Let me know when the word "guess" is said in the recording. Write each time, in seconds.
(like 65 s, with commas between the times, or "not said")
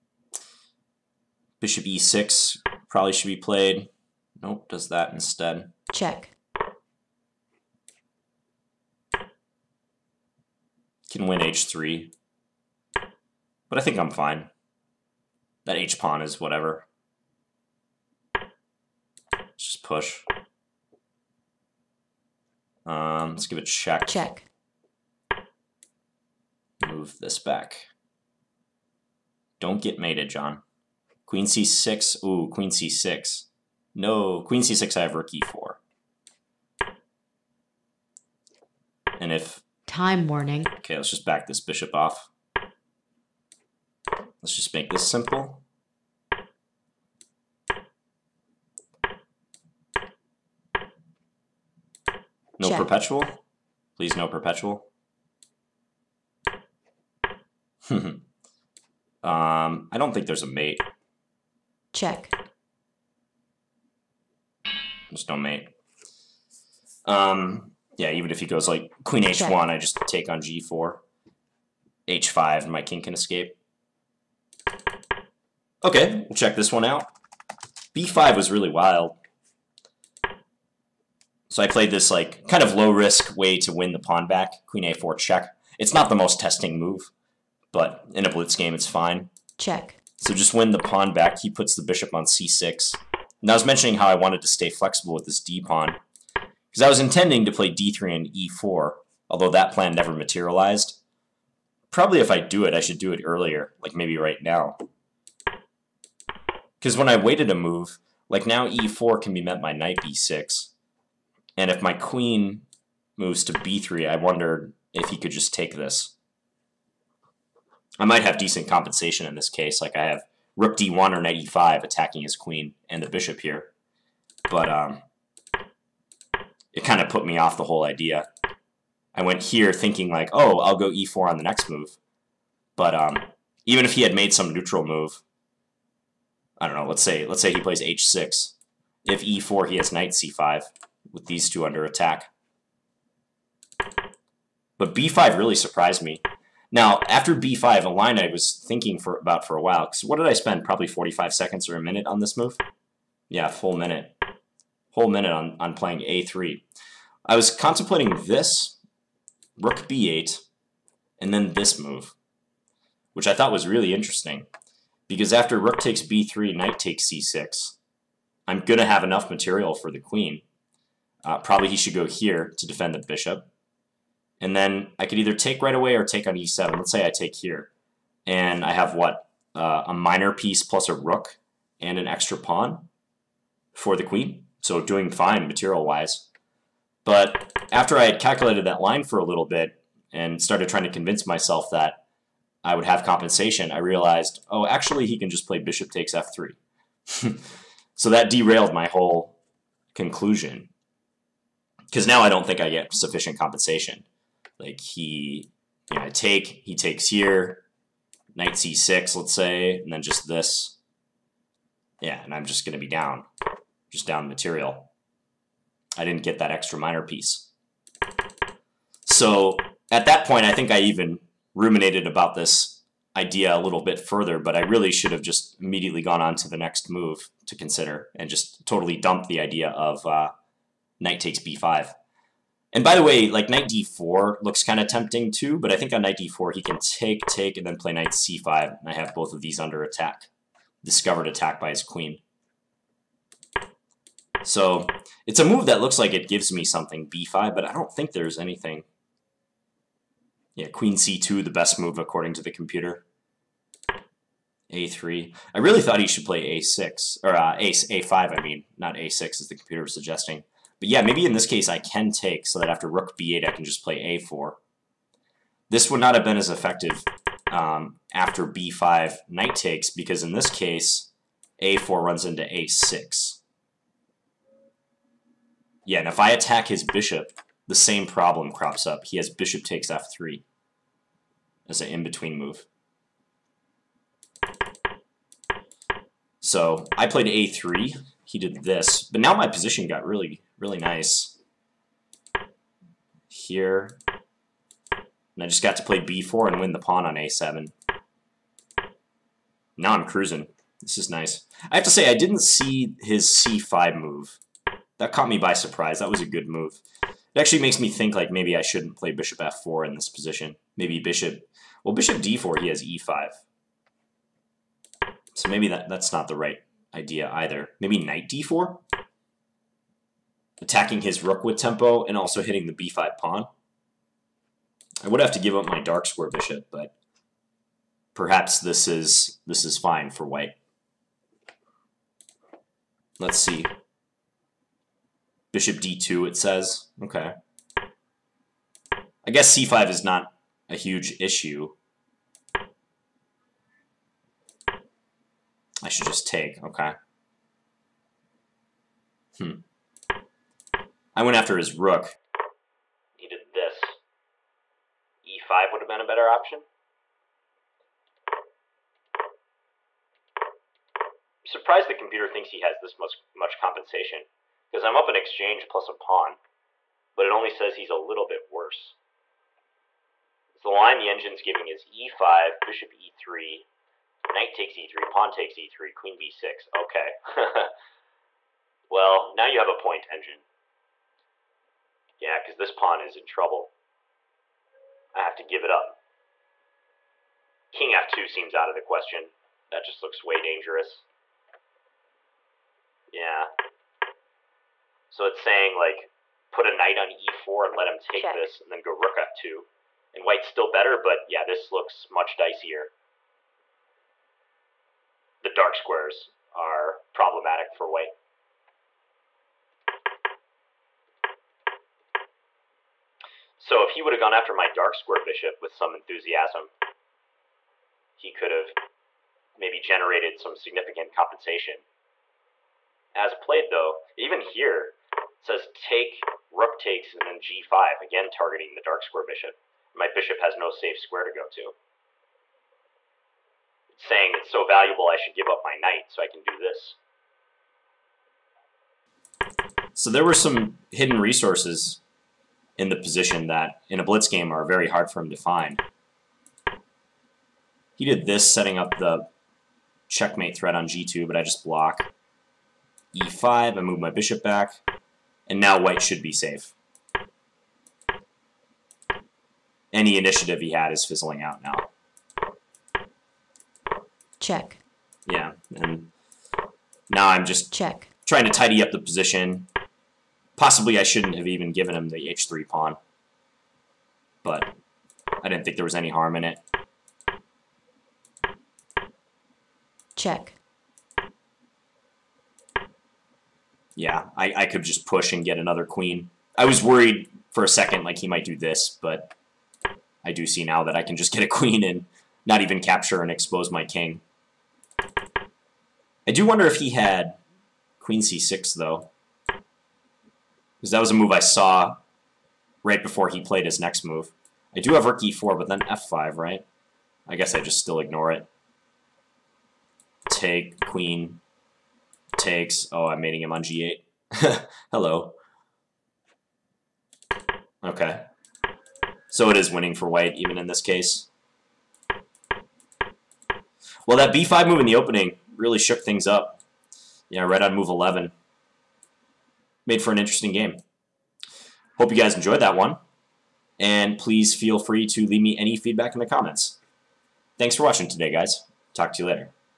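339 s, 507 s.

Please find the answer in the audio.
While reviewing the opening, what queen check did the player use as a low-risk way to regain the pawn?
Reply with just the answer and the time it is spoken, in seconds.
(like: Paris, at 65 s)
Queen a4, at 84 s.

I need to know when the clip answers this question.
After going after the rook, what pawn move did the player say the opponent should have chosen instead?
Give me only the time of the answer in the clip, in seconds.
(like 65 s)
355 s.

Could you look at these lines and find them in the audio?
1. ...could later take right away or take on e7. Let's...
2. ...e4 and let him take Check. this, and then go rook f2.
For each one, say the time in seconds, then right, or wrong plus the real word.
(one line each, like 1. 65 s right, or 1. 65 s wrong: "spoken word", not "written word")
1. 175 s wrong: "either", not "later"
2. 397 s right.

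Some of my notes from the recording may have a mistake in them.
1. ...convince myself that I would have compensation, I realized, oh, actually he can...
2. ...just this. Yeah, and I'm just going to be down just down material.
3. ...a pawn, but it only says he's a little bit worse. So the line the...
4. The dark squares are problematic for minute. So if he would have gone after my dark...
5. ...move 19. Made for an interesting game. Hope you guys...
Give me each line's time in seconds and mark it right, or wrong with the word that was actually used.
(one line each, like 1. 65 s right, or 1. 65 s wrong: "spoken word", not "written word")
1. 190 s right
2. 210 s right
3. 365 s right
4. 405 s wrong: "white", not "minute"
5. 527 s wrong: "11", not "19".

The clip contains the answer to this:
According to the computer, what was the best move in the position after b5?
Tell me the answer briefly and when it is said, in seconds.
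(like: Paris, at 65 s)
Queen c2, at 250 s.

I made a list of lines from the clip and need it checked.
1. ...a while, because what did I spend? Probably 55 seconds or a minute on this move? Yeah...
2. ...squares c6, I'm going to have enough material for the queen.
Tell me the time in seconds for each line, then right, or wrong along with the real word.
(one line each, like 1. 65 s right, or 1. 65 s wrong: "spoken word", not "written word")
1. 149 s wrong: "45", not "55"
2. 166 s wrong: "takes", not "squares".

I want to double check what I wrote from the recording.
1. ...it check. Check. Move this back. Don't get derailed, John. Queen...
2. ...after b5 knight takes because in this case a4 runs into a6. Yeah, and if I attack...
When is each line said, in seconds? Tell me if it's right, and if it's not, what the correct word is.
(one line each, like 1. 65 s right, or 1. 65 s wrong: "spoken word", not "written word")
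1. 23 s wrong: "mated", not "derailed"
2. 268 s right.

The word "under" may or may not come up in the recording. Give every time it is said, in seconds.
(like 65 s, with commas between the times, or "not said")
141 s, 239 s.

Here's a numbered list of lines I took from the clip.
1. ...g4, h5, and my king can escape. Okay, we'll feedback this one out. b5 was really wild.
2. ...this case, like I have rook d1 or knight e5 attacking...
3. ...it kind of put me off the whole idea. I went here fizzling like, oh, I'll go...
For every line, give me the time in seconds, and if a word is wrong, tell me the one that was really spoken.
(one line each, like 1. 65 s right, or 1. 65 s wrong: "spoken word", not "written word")
1. 70 s wrong: "check", not "feedback"
2. 119 s right
3. 126 s wrong: "thinking", not "fizzling".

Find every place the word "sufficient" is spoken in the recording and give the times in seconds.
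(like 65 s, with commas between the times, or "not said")
202 s.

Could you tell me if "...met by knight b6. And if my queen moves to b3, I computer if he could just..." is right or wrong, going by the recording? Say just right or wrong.
wrong.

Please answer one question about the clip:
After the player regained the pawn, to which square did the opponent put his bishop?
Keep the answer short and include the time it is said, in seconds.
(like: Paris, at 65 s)
c6, at 91 s.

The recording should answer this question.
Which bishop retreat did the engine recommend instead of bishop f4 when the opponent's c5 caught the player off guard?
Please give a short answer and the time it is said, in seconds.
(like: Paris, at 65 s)
Bishop d2, at 335 s.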